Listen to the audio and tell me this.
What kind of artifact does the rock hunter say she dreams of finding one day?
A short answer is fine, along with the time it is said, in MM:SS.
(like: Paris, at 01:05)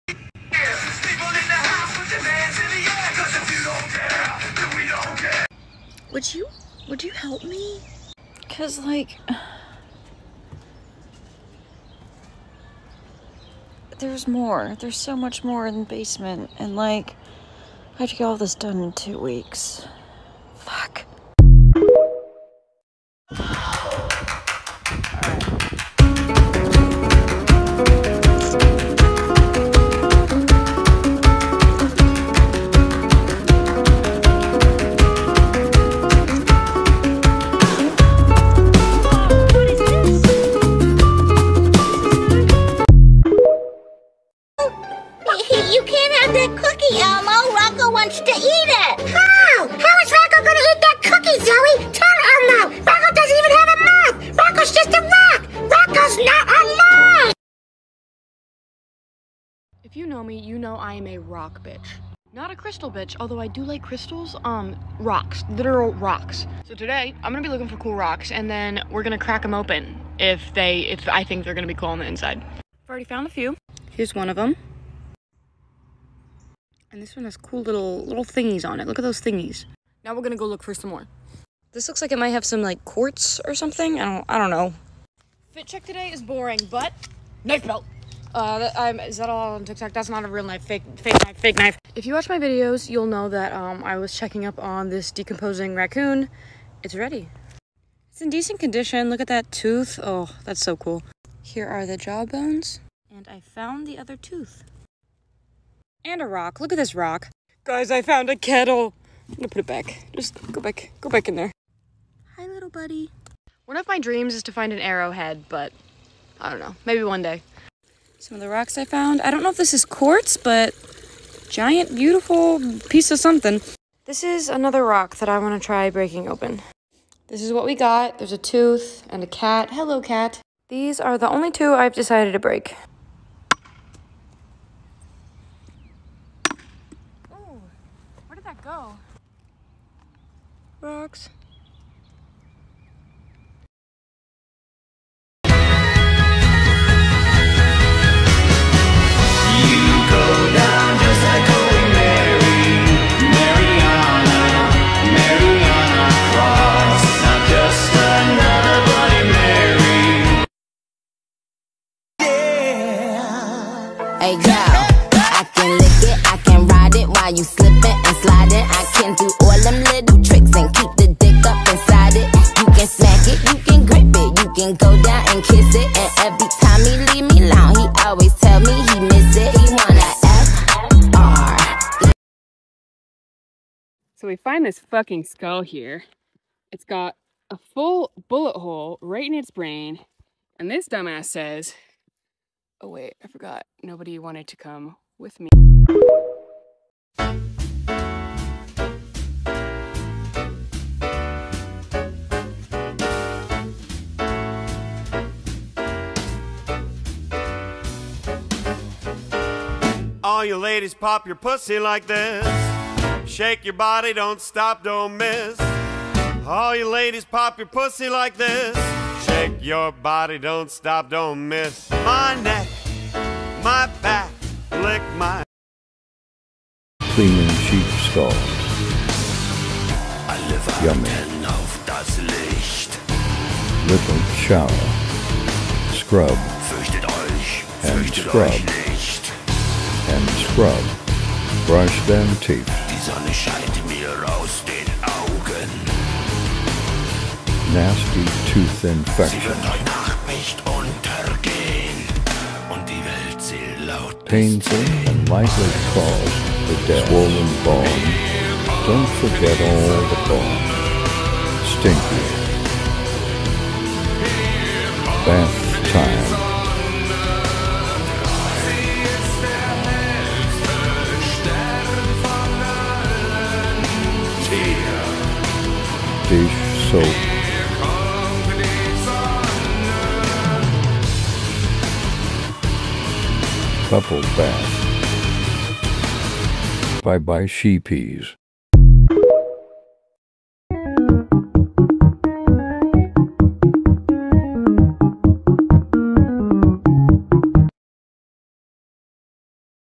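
arrowhead, at 01:54.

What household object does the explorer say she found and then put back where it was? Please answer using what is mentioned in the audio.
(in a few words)
kettle.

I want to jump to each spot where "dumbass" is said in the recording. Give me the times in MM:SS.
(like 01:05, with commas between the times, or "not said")
03:10.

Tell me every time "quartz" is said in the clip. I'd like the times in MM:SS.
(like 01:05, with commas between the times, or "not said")
01:22, 01:59.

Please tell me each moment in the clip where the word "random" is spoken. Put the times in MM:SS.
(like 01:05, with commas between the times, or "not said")
not said.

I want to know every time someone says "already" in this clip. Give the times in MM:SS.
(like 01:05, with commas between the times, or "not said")
01:12.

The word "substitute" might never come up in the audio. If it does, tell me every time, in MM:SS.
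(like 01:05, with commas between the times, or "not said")
not said.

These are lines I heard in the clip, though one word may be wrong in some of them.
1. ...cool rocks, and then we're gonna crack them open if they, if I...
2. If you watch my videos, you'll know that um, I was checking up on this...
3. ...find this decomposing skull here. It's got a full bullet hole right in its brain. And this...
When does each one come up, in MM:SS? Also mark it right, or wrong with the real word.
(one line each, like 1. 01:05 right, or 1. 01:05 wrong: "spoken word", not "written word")
1. 01:07 right
2. 01:31 right
3. 03:04 wrong: "fucking", not "decomposing".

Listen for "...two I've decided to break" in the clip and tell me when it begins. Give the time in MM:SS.
02:11.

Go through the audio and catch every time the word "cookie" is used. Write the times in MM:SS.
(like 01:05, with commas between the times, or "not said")
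00:51.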